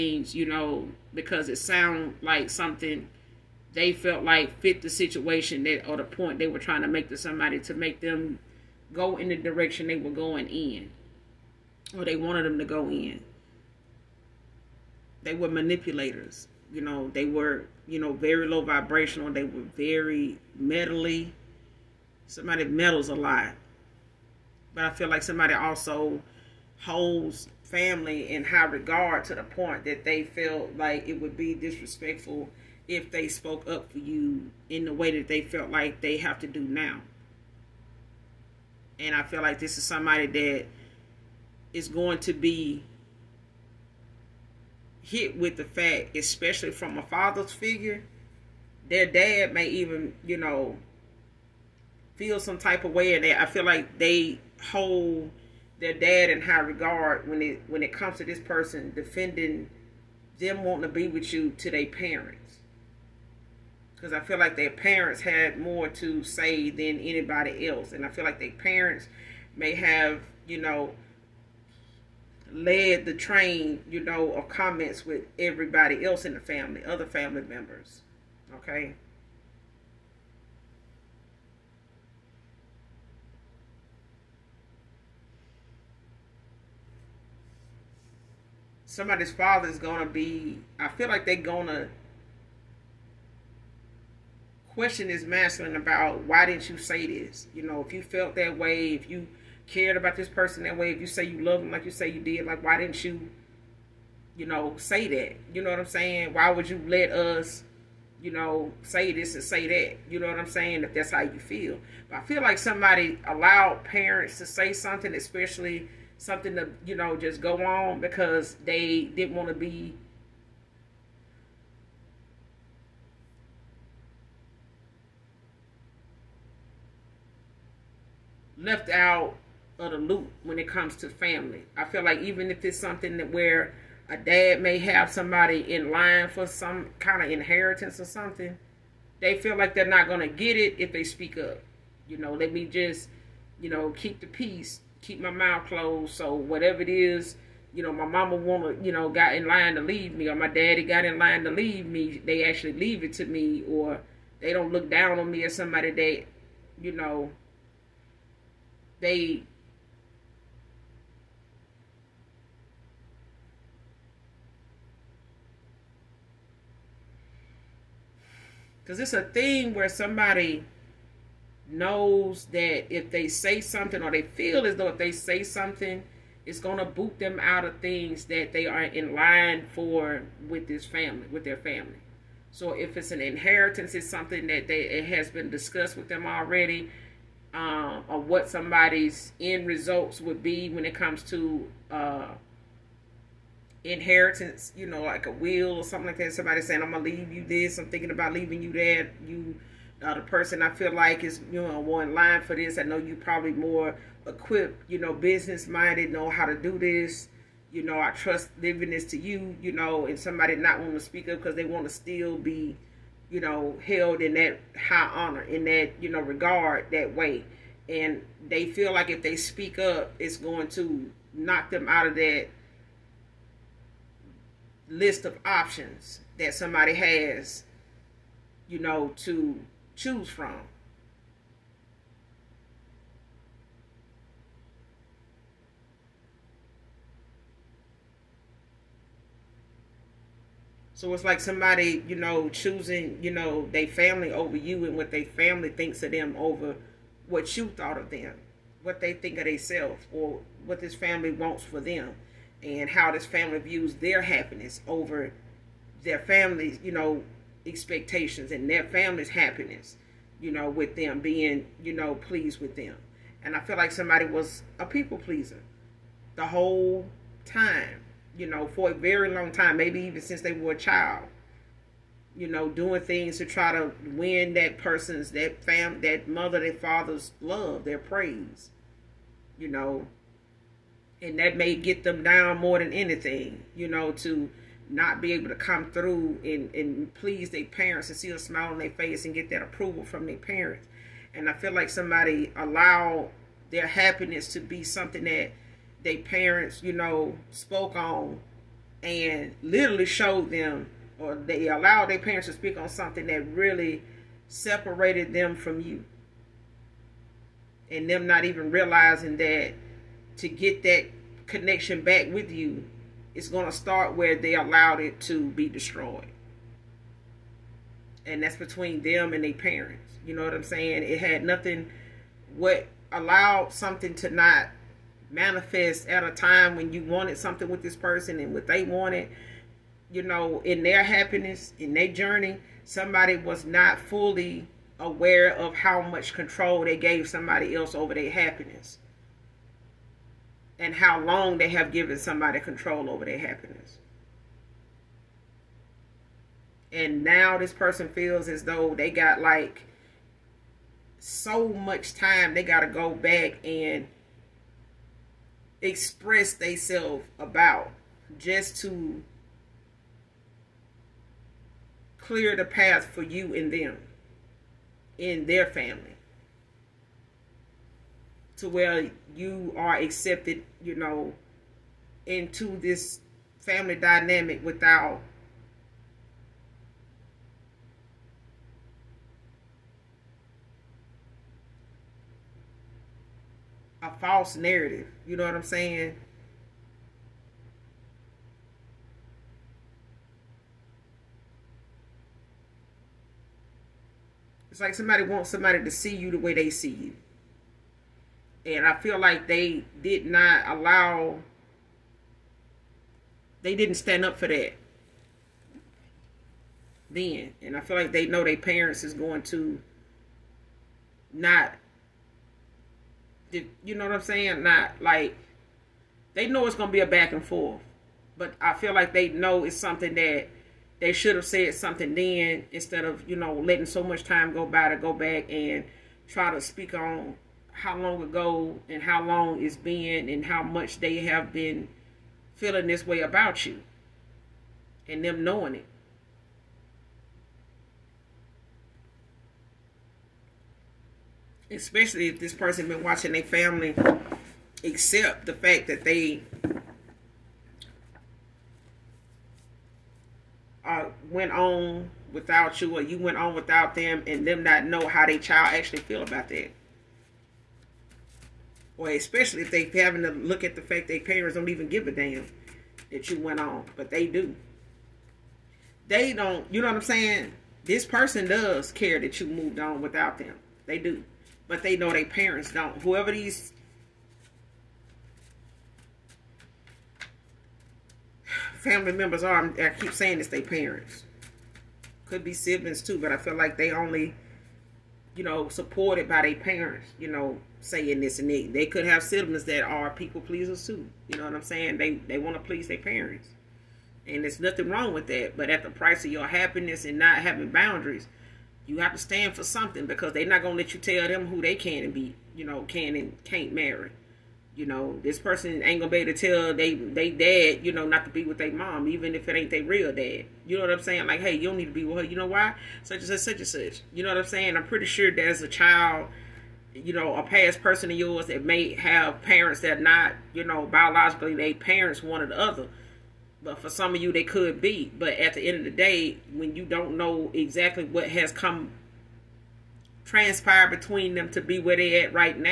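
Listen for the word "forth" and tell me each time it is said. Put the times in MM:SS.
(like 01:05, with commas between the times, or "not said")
06:57.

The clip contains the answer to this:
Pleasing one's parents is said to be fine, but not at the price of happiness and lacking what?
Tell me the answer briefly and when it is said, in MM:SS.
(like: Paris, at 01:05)
boundaries, at 08:17.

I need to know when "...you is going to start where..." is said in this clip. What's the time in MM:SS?
05:12.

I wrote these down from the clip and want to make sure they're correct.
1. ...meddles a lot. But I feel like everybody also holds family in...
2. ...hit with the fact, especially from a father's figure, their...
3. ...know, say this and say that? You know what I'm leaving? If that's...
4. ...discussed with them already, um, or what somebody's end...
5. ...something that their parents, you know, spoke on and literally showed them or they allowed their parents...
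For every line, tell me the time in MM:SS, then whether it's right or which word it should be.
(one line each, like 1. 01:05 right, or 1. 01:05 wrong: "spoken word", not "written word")
1. 00:22 wrong: "somebody", not "everybody"
2. 00:45 right
3. 01:48 wrong: "saying", not "leaving"
4. 03:05 right
5. 04:54 right.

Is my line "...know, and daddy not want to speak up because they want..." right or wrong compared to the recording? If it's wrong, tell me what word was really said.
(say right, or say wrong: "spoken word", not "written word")
wrong: "somebody", not "daddy".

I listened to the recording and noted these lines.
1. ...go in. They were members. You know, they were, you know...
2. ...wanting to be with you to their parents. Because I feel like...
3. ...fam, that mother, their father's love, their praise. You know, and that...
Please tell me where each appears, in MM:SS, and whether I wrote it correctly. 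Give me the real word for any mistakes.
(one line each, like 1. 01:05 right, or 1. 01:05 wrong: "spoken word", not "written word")
1. 00:12 wrong: "manipulators", not "members"
2. 01:00 right
3. 04:35 right.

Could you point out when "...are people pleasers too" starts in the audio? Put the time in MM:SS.
08:09.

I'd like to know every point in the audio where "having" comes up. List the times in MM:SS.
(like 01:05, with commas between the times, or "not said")
07:40, 08:17.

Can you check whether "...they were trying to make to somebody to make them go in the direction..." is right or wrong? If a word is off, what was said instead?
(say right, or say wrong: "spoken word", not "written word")
right.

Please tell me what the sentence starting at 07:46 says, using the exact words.
They don't, you know what I'm saying?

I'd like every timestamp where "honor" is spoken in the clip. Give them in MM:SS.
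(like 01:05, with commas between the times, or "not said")
03:35.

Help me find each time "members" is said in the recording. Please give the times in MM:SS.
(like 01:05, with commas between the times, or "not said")
01:17, 07:59.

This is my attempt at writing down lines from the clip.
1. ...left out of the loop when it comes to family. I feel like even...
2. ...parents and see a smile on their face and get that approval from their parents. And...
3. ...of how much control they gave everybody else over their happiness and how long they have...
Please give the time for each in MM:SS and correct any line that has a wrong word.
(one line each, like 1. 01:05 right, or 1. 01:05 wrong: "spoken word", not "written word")
1. 02:08 right
2. 04:47 right
3. 05:35 wrong: "somebody", not "everybody".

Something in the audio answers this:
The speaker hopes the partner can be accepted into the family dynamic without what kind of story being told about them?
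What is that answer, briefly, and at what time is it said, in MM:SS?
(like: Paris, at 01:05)
a false narrative, at 06:24.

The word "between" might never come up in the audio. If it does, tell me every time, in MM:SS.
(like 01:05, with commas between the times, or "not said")
05:18, 08:50.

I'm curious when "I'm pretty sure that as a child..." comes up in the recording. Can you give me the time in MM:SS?
08:34.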